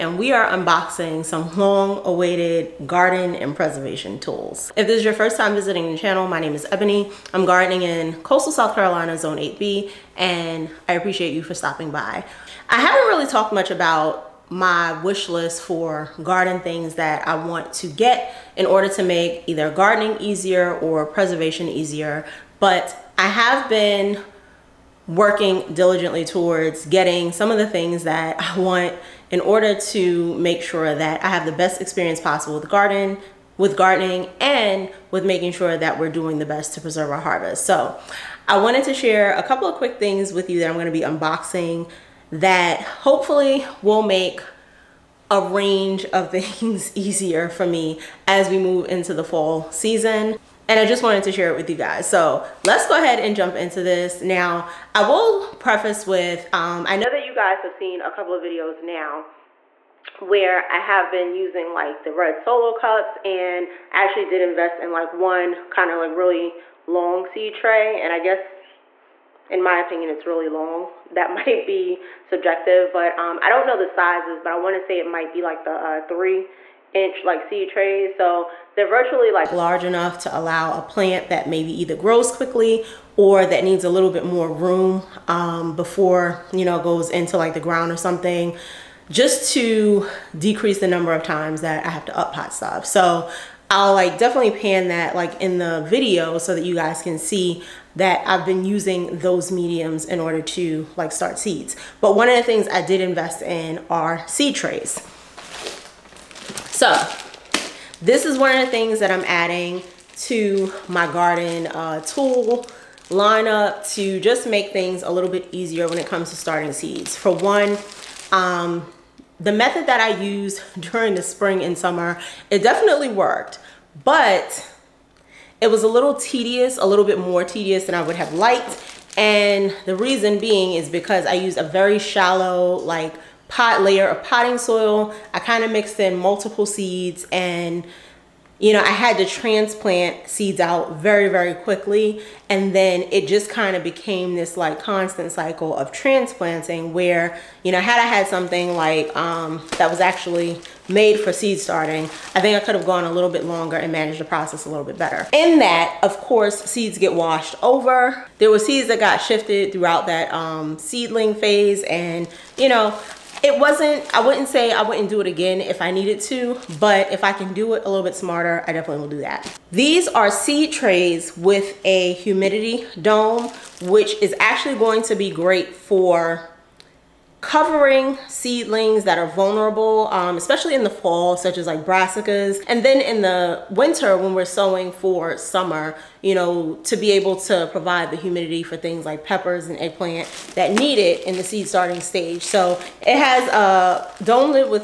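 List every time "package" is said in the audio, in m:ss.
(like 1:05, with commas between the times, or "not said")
not said.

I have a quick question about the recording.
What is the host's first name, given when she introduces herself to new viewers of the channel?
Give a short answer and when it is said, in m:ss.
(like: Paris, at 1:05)
Ebony, at 0:06.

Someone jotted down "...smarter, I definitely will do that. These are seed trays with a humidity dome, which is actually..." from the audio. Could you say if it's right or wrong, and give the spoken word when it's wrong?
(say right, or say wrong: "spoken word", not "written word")
right.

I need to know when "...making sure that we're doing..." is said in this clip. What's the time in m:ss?
0:35.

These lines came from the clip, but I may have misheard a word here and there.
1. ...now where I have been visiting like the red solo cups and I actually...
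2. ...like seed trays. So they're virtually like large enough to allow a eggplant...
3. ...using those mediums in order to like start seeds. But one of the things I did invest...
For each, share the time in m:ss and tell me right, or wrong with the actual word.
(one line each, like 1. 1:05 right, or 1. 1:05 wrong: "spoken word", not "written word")
1. 0:58 wrong: "using", not "visiting"
2. 1:17 wrong: "plant", not "eggplant"
3. 1:38 right.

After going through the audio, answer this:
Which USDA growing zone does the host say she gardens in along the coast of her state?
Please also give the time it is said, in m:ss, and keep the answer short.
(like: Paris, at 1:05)
8B, at 0:09.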